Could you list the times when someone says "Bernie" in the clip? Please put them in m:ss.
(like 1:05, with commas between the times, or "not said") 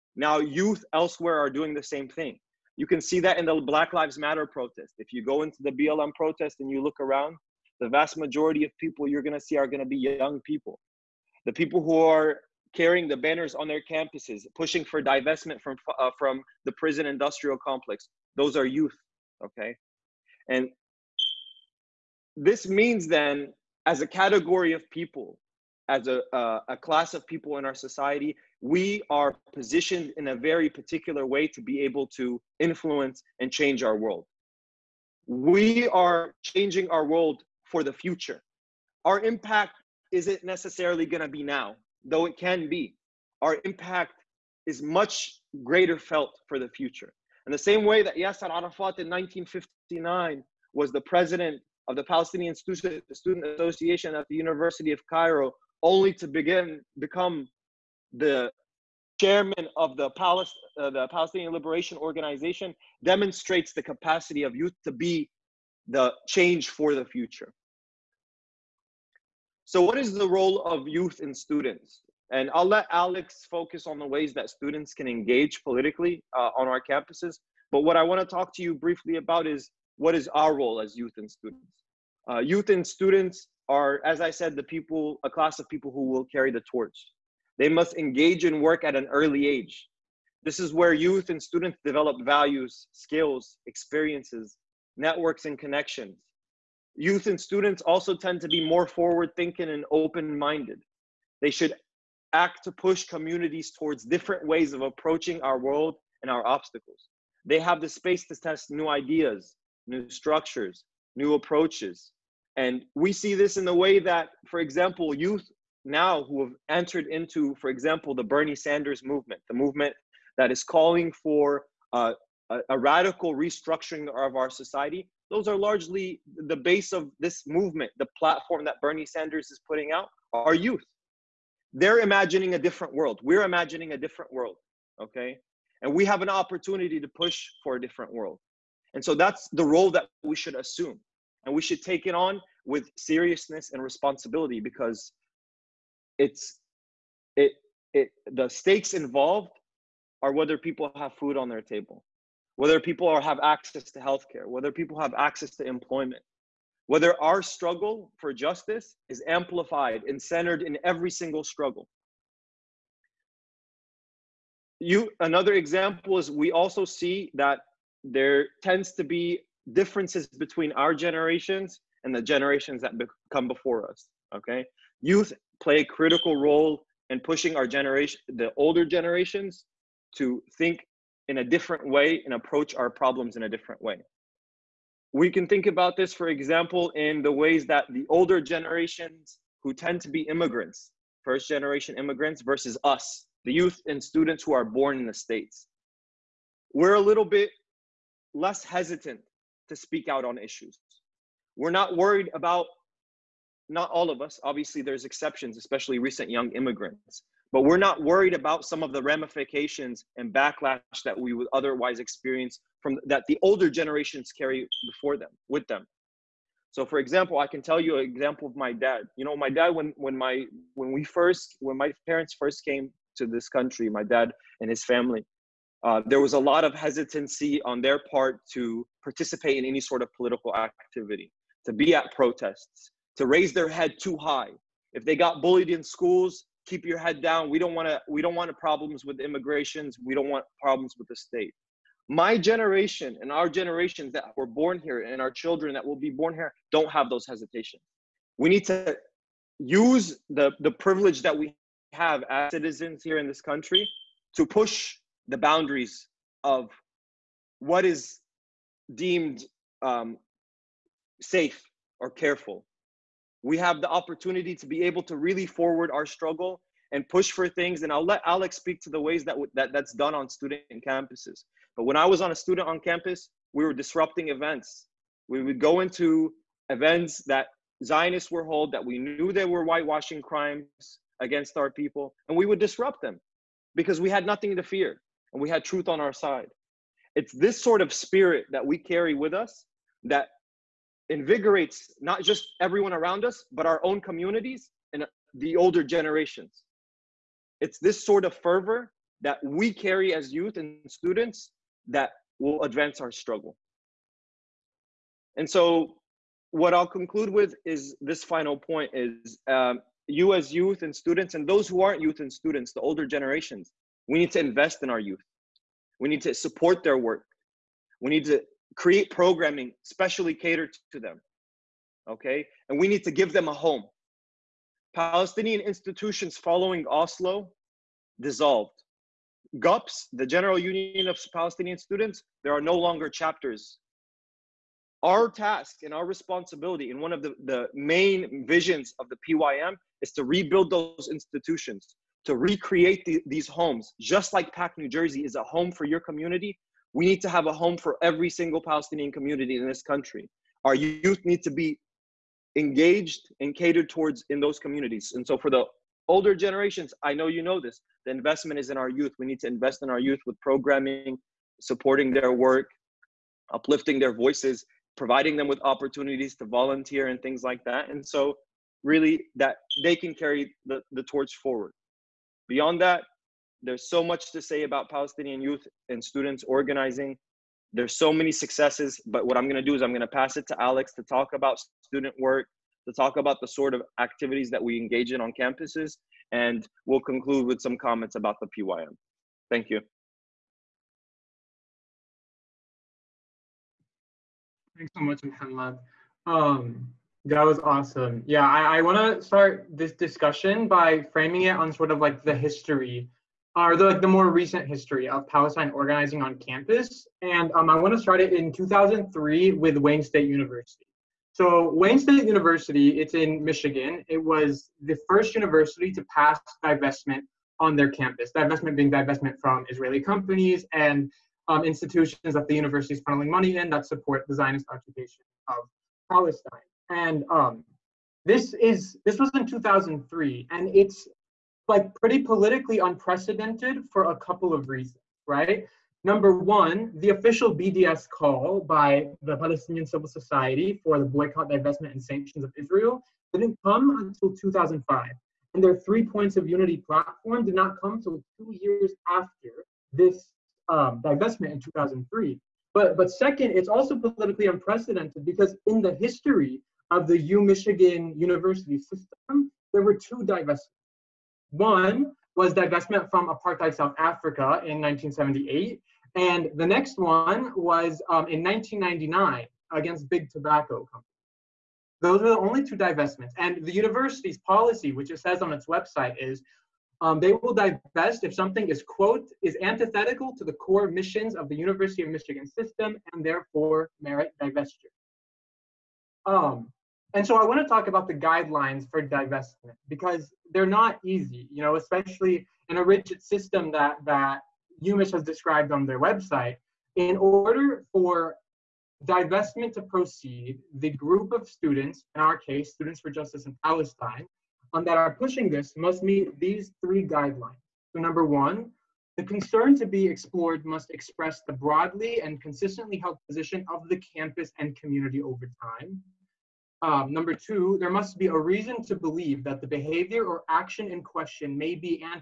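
1:58, 2:08.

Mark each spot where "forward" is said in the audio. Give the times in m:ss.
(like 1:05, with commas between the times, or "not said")
1:38, 4:25, 6:11.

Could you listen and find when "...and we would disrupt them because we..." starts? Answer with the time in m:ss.
4:42.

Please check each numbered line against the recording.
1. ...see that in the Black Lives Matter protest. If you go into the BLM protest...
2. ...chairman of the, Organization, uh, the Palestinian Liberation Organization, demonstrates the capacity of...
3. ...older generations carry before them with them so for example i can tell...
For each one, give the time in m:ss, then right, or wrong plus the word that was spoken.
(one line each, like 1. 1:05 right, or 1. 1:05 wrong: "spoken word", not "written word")
1. 0:03 right
2. 0:59 wrong: "Palest", not "Organization"
3. 3:33 right.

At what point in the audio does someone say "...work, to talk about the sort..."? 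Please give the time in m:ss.
6:22.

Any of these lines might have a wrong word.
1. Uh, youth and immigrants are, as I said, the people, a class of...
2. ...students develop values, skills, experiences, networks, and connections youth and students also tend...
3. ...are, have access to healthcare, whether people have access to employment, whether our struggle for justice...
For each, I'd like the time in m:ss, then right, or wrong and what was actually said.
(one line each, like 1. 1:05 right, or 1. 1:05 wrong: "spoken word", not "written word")
1. 1:22 wrong: "students", not "immigrants"
2. 1:31 right
3. 2:33 right.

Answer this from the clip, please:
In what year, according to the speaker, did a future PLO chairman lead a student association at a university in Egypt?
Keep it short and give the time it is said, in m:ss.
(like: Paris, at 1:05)
1959, at 0:49.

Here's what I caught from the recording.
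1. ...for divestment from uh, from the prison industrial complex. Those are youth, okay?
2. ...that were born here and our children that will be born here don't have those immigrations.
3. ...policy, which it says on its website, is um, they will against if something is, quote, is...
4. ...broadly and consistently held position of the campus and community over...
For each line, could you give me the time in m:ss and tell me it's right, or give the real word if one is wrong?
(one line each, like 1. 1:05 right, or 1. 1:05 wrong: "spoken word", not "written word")
1. 0:14 right
2. 4:04 wrong: "hesitations", not "immigrations"
3. 7:54 wrong: "divest", not "against"
4. 8:31 right.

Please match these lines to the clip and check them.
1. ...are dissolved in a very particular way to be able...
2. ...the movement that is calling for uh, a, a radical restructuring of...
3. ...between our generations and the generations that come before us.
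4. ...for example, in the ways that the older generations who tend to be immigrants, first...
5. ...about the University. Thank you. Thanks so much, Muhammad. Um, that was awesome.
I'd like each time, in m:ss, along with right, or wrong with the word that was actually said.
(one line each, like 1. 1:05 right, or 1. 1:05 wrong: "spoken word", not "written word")
1. 0:29 wrong: "positioned", not "dissolved"
2. 1:59 right
3. 2:50 right
4. 3:06 right
5. 6:28 wrong: "PYM", not "University".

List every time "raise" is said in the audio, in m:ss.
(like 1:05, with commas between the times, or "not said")
3:53.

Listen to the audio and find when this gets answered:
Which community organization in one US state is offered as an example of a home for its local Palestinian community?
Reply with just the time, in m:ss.
5:44.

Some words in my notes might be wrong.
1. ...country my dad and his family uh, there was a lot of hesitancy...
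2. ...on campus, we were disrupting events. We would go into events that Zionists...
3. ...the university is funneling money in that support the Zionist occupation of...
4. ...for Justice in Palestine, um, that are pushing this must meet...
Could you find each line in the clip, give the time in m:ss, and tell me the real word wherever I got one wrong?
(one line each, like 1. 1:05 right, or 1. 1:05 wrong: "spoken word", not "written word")
1. 3:43 right
2. 4:32 right
3. 7:02 right
4. 8:23 right.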